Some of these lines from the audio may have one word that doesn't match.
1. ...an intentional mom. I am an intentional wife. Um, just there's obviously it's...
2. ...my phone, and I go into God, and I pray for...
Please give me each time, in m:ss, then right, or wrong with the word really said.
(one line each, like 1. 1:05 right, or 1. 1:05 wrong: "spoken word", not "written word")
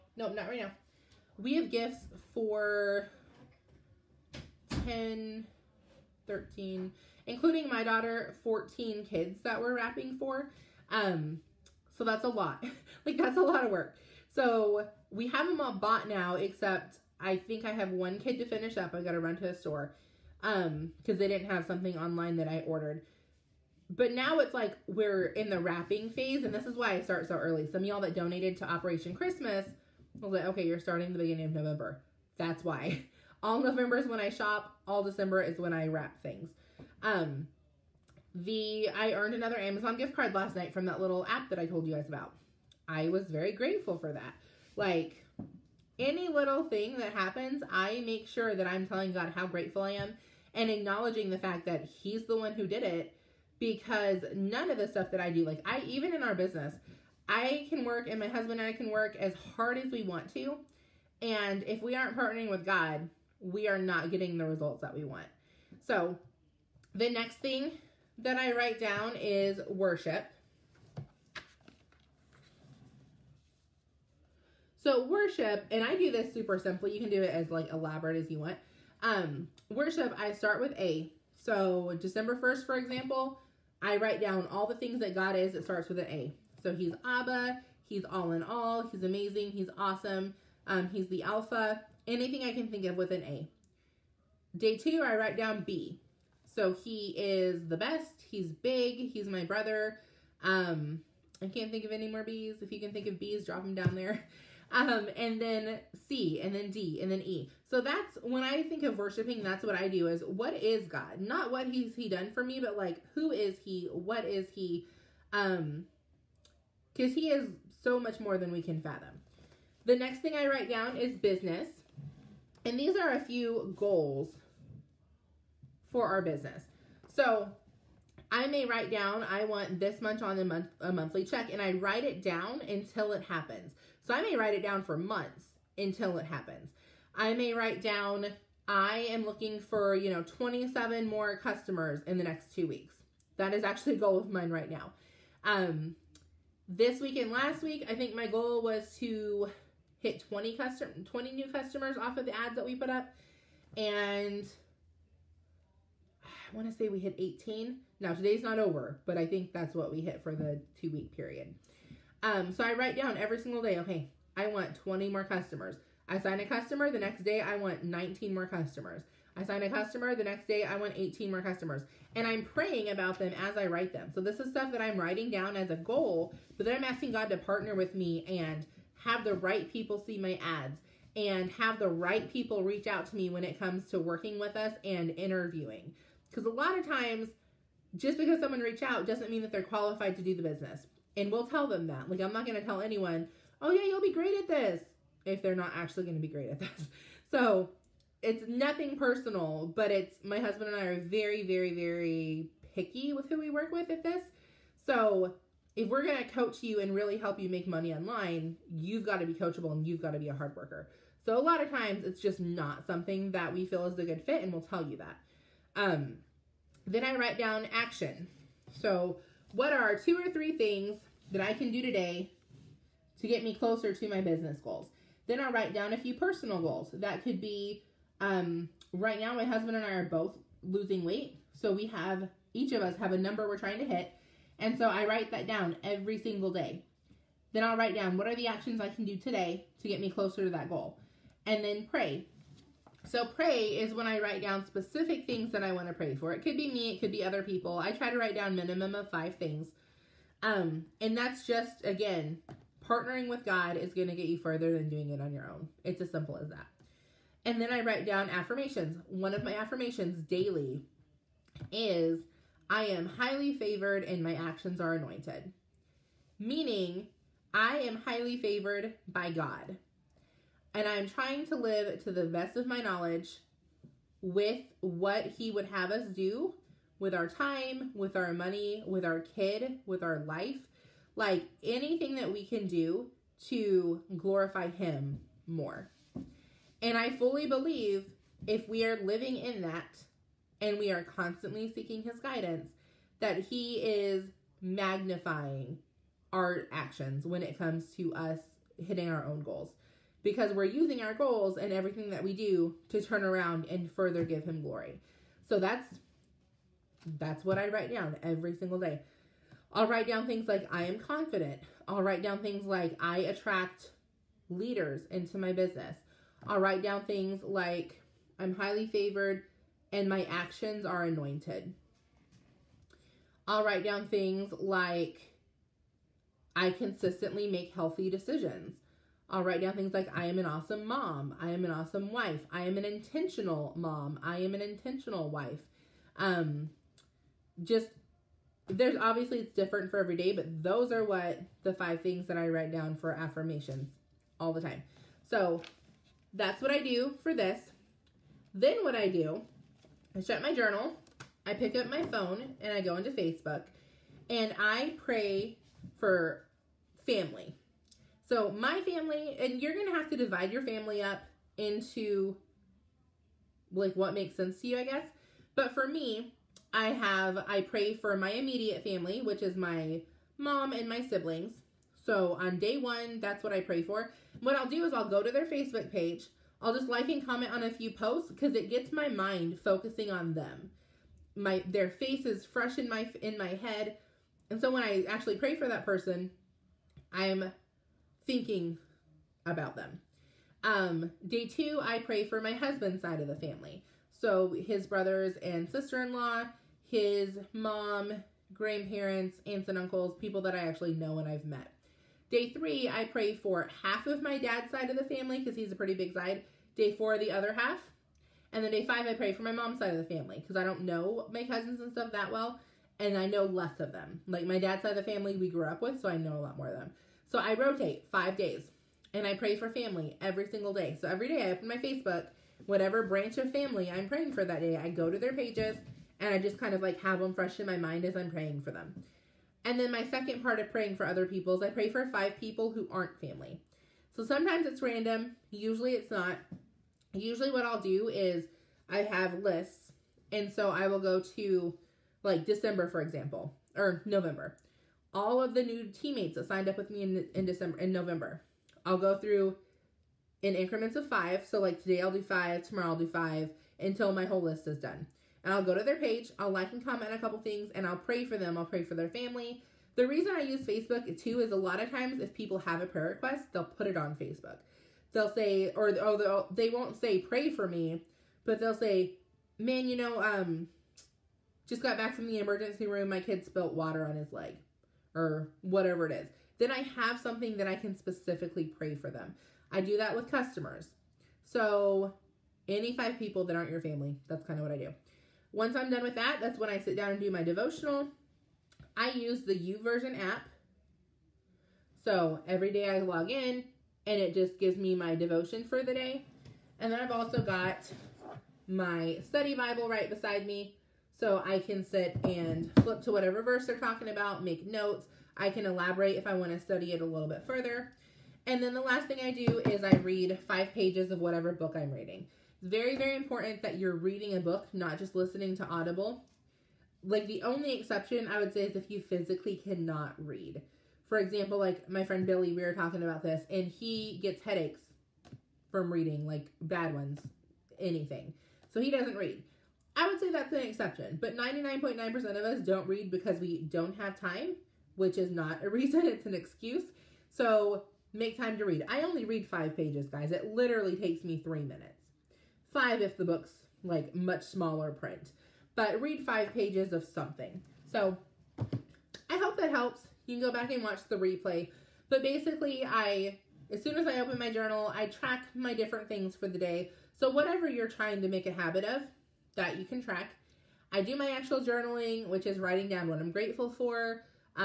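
1. 5:32 right
2. 5:51 wrong: "Facebook", not "God".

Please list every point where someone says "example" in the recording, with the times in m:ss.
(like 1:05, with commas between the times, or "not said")
1:22, 7:23, 8:41.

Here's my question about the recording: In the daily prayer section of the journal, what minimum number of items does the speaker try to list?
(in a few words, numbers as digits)
5.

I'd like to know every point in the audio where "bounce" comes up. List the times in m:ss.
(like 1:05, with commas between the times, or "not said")
not said.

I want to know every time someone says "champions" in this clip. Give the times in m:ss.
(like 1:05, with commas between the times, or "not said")
not said.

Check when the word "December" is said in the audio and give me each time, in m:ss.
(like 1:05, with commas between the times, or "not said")
0:35, 1:22, 7:22, 7:27.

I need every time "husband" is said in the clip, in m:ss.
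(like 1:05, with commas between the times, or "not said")
0:58, 3:20, 3:49, 6:32.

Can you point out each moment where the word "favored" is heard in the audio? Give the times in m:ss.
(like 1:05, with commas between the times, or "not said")
4:23, 4:28, 5:18.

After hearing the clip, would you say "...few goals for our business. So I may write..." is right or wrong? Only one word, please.
right.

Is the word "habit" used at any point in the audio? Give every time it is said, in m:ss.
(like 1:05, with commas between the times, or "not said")
9:18.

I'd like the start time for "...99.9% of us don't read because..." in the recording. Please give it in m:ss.
8:51.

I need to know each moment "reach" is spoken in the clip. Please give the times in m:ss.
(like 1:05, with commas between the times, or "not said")
3:02, 3:08.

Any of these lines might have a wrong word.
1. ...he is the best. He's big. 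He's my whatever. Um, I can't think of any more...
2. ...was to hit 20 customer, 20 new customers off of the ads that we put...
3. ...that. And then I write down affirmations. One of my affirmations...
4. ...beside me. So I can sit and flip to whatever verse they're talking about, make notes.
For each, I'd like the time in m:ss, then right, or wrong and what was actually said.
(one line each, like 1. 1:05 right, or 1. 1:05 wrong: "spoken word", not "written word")
1. 1:36 wrong: "brother", not "whatever"
2. 2:28 right
3. 4:16 right
4. 8:20 right.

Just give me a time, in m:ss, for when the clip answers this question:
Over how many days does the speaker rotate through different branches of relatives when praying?
6:57.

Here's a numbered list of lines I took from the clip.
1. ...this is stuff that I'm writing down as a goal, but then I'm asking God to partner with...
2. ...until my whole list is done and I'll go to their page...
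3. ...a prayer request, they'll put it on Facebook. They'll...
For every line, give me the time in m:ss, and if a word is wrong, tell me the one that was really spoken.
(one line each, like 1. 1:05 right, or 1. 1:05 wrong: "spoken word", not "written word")
1. 2:54 right
2. 7:33 right
3. 7:42 right.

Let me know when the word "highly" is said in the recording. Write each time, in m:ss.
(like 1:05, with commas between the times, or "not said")
4:23, 4:28, 5:18.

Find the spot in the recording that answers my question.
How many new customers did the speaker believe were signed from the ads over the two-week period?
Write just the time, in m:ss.
2:36.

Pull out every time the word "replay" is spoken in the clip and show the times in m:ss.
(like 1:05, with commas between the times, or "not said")
9:11.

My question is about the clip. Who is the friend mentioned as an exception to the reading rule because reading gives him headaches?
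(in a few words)
Billy.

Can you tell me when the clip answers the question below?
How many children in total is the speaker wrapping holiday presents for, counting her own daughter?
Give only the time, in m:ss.
0:08.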